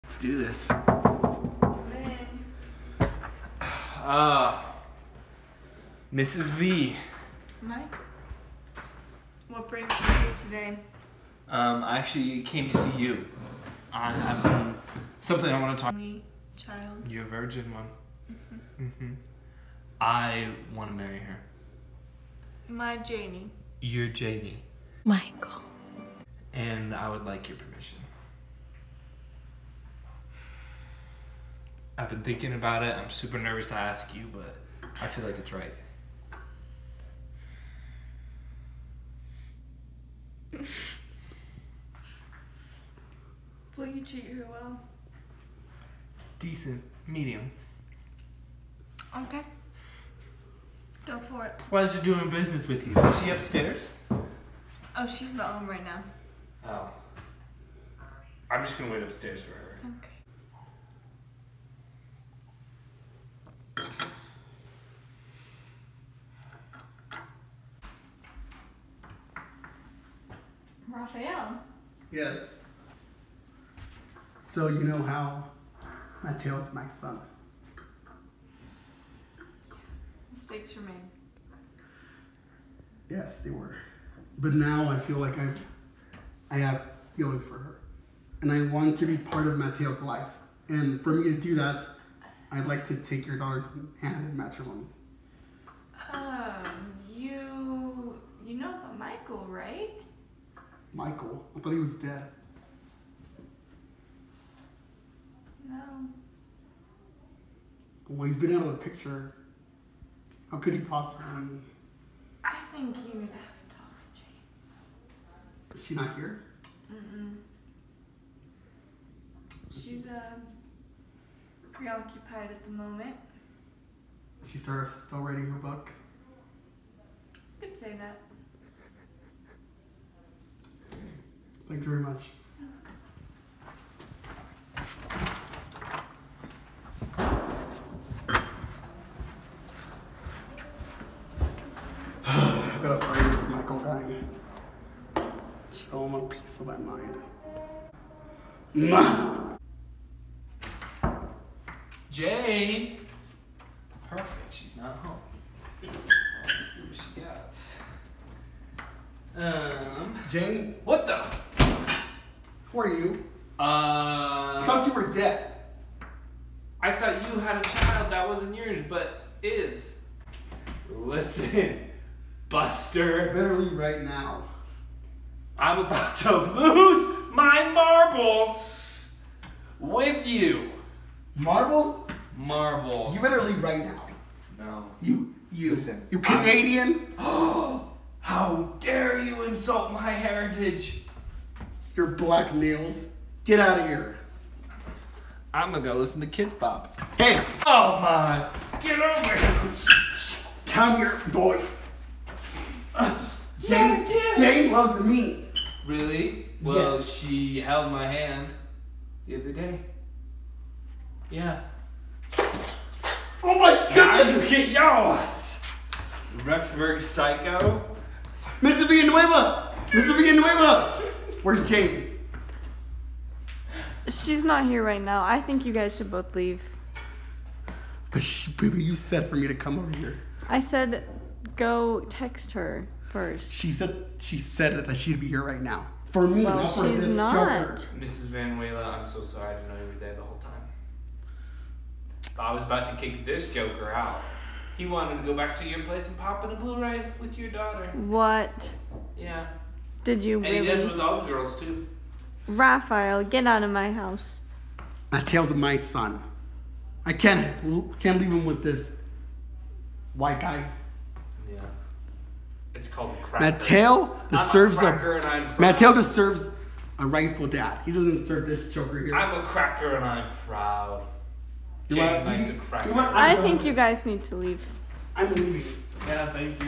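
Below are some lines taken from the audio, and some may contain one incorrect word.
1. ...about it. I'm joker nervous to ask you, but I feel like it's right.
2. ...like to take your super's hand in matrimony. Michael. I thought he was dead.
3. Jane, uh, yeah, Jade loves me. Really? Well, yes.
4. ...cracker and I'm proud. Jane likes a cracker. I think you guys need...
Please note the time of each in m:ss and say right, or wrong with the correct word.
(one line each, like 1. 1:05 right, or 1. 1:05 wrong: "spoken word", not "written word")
1. 0:32 wrong: "super", not "joker"
2. 1:32 wrong: "daughter", not "super"
3. 3:22 wrong: "Jane", not "Jade"
4. 4:29 right.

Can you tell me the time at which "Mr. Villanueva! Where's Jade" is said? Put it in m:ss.
3:39.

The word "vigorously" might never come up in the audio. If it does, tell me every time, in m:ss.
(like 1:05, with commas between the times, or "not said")
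not said.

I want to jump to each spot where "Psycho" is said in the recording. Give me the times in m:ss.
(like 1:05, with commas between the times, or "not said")
3:37.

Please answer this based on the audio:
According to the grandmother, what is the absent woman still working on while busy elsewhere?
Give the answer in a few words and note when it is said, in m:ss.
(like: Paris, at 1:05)
her book, at 2:05.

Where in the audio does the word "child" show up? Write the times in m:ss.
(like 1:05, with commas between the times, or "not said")
0:16, 2:47.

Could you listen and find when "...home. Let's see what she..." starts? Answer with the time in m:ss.
2:34.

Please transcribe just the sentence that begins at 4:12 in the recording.
Rafael, get out of my house.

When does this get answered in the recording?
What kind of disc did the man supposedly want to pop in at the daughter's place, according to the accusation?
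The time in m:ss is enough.
4:06.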